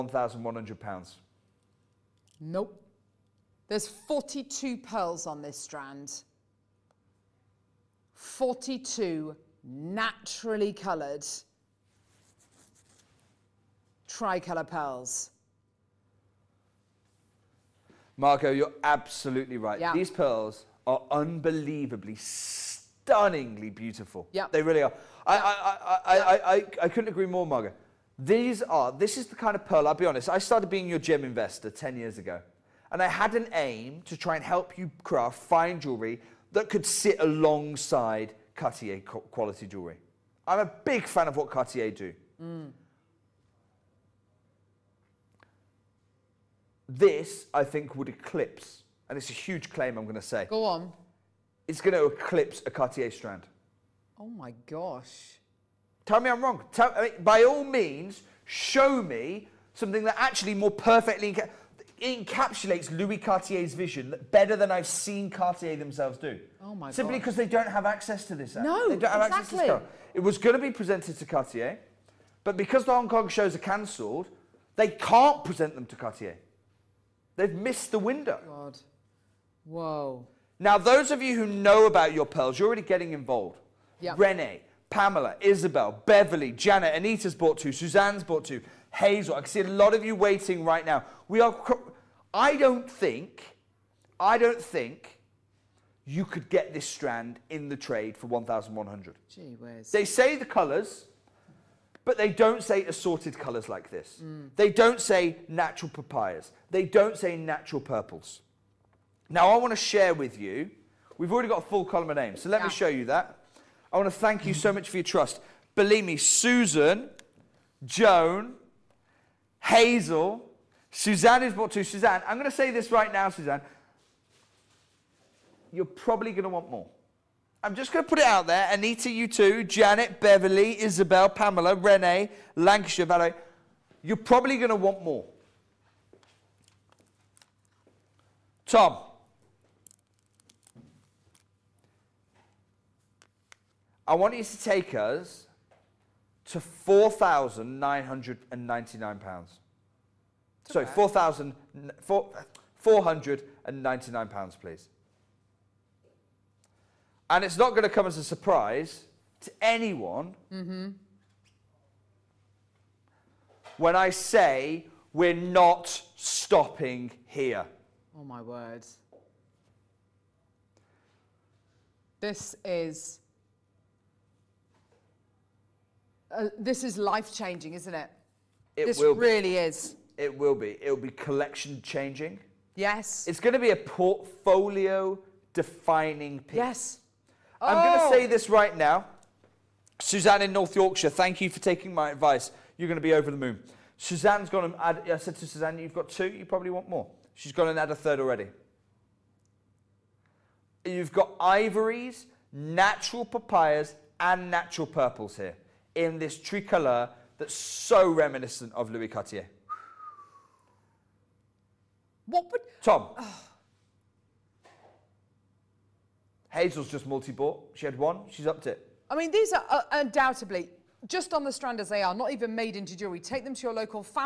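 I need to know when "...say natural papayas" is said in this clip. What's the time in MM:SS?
01:44.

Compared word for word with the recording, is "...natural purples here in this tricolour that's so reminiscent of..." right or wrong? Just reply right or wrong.
right.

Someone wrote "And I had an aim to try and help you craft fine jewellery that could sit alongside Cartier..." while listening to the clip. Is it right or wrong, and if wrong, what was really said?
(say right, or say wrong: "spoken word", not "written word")
right.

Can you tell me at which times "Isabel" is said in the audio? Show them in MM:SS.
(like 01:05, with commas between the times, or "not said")
01:25, 02:10.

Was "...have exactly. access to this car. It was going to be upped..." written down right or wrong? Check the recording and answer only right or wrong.
wrong.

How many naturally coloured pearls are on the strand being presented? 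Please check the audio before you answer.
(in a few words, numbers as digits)
42.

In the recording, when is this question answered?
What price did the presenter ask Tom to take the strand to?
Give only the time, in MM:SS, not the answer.
02:26.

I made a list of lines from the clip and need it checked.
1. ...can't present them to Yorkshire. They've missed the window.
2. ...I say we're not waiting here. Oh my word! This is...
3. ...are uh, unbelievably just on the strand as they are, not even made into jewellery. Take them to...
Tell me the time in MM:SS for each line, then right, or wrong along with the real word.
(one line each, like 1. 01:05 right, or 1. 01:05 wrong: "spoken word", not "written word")
1. 01:14 wrong: "Cartier", not "Yorkshire"
2. 02:44 wrong: "stopping", not "waiting"
3. 03:39 wrong: "undoubtedly", not "unbelievably".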